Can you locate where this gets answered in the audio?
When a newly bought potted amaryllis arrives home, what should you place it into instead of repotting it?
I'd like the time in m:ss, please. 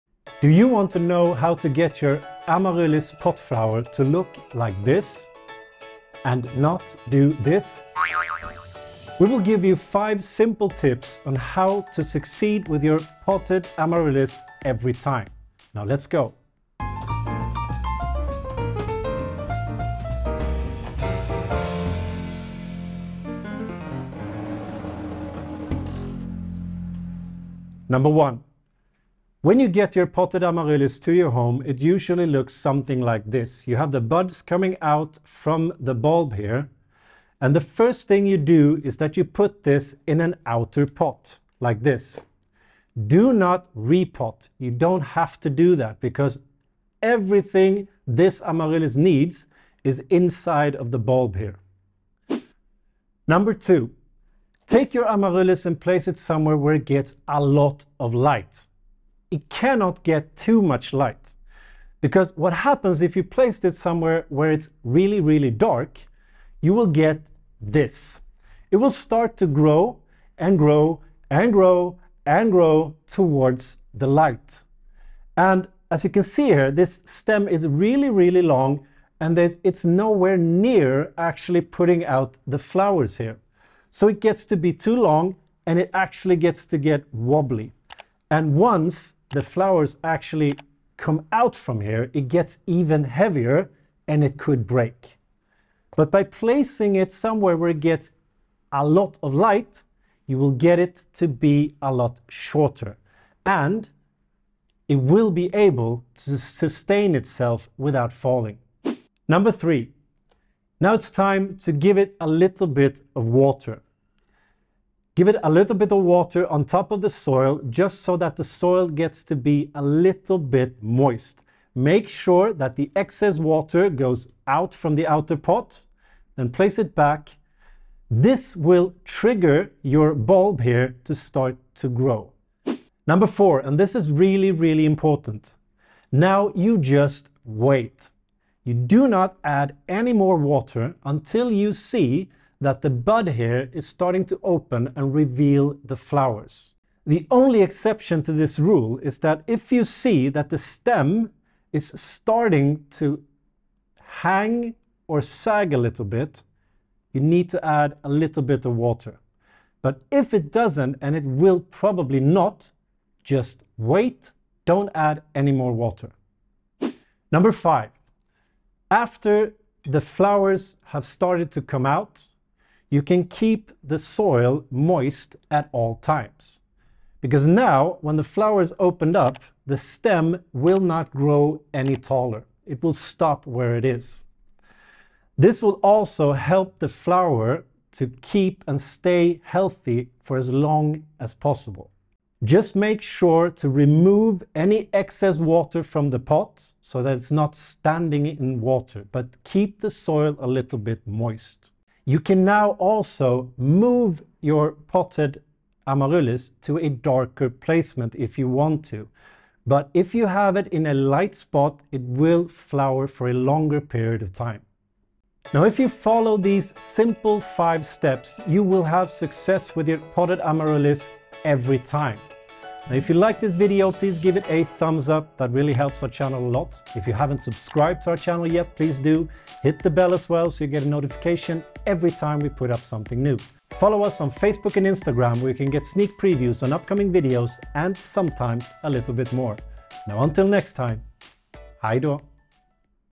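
0:40.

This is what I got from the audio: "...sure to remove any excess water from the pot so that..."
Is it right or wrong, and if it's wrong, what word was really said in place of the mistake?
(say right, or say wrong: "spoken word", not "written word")
right.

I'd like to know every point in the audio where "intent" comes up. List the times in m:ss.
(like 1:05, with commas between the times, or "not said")
not said.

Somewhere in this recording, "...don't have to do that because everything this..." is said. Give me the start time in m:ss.
0:44.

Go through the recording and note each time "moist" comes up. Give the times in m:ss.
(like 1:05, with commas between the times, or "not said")
2:00, 2:54, 3:21.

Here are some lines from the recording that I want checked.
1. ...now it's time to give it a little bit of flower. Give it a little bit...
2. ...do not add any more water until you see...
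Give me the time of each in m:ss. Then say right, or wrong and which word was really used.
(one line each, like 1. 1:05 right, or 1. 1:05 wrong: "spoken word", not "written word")
1. 1:50 wrong: "water", not "flower"
2. 2:18 right.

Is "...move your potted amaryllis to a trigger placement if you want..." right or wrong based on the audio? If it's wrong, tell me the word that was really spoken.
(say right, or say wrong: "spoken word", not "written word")
wrong: "darker", not "trigger".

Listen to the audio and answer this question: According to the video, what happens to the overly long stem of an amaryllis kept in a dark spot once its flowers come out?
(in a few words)
It could break.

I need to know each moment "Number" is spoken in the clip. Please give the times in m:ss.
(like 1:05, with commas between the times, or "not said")
0:27, 0:53, 1:49, 2:13, 2:47.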